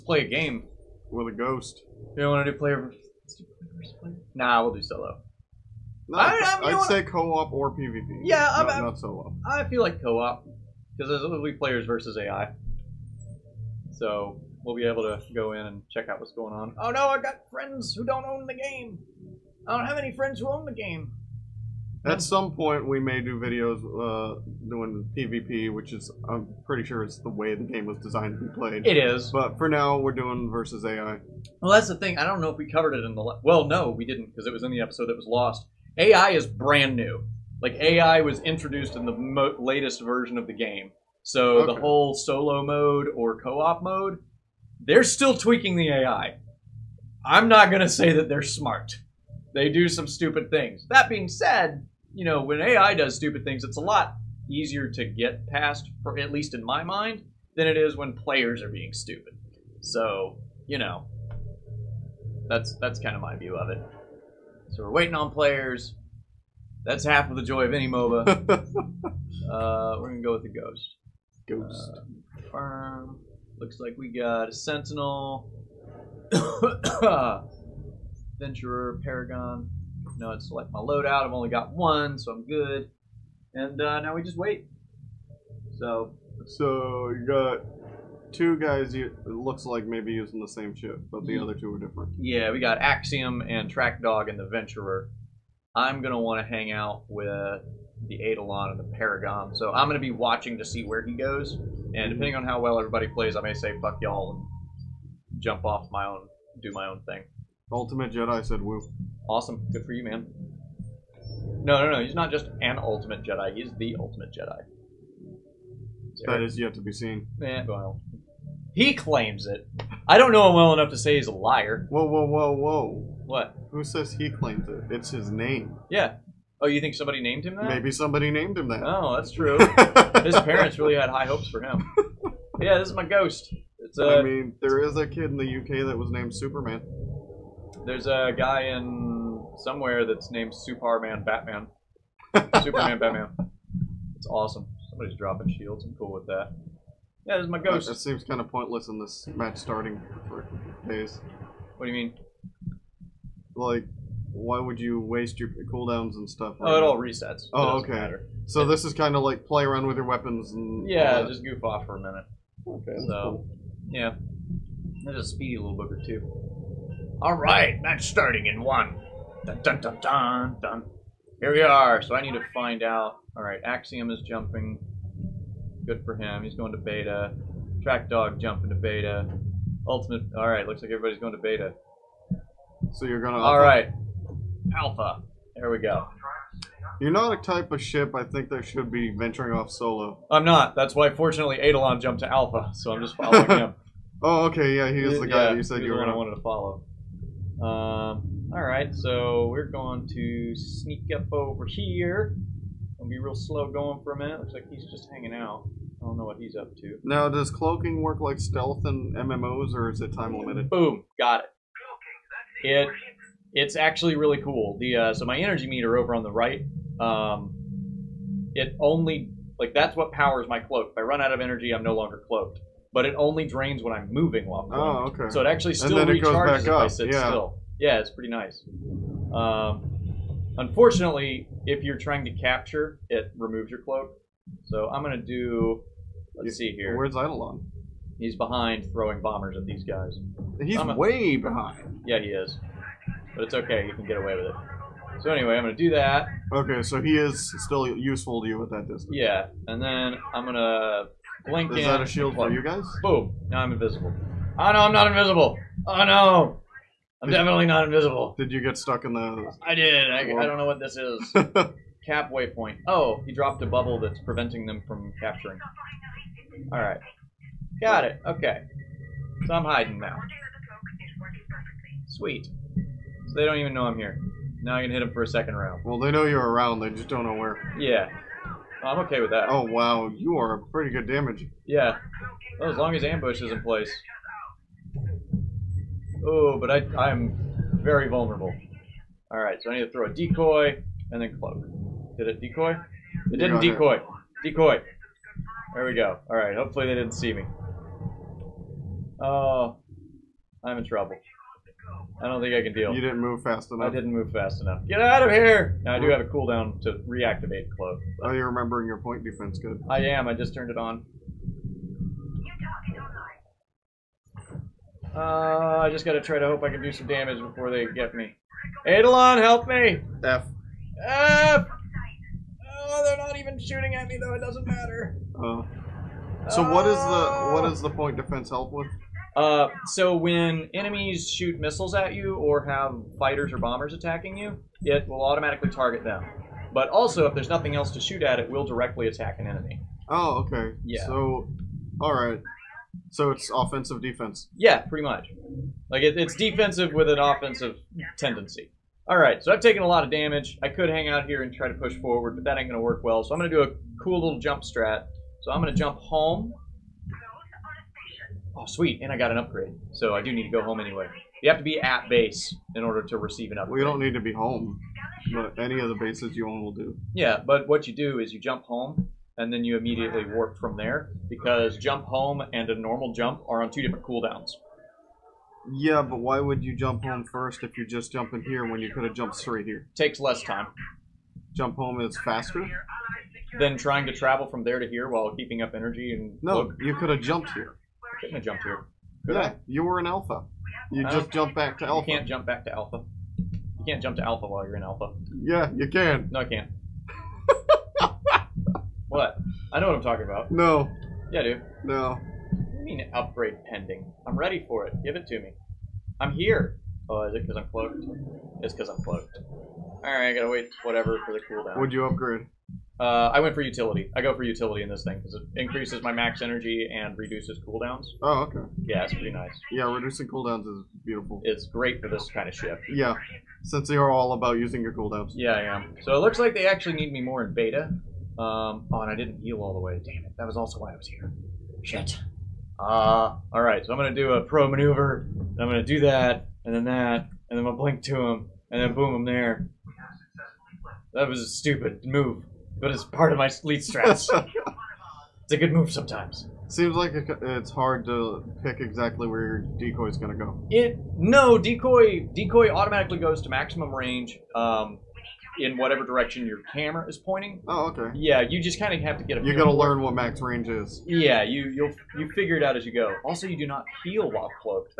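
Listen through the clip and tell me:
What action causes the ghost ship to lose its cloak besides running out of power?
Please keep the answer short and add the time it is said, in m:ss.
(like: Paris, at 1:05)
Capturing, at 3:51.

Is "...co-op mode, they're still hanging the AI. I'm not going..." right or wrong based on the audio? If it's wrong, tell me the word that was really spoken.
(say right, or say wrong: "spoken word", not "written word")
wrong: "tweaking", not "hanging".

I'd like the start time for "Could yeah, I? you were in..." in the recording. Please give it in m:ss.
6:29.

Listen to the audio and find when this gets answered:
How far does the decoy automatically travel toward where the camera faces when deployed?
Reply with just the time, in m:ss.
7:33.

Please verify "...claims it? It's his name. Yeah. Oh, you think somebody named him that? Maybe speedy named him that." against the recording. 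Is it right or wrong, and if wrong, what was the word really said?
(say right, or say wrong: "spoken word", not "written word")
wrong: "somebody", not "speedy".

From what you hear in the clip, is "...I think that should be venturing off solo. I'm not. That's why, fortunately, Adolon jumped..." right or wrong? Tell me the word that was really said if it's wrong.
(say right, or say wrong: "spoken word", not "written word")
right.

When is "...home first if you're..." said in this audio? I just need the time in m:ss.
6:17.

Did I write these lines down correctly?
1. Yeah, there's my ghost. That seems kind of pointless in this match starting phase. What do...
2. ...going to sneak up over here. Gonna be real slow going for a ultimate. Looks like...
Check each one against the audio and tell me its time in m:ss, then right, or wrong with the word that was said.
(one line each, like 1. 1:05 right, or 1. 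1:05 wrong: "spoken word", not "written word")
1. 2:27 right
2. 3:19 wrong: "minute", not "ultimate".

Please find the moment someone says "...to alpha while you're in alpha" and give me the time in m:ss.
6:34.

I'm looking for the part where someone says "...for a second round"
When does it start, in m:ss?
4:35.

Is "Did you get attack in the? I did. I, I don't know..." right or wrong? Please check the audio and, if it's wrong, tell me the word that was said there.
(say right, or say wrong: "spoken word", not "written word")
wrong: "stuck", not "attack".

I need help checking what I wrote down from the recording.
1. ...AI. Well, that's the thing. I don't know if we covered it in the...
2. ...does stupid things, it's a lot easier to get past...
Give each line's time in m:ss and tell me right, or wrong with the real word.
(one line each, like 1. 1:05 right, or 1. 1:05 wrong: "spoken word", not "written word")
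1. 0:30 right
2. 0:52 right.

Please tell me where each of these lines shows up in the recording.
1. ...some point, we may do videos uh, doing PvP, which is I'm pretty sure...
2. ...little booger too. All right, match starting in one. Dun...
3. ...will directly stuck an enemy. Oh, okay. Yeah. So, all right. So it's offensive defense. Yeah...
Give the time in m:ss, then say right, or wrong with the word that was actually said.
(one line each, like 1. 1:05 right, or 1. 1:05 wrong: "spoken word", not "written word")
1. 0:22 right
2. 2:45 right
3. 5:38 wrong: "attack", not "stuck".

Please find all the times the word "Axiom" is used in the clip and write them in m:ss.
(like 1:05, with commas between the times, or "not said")
1:32, 2:53.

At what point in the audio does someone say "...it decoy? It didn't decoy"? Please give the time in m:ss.
4:52.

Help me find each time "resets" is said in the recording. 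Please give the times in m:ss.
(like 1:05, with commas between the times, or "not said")
2:36.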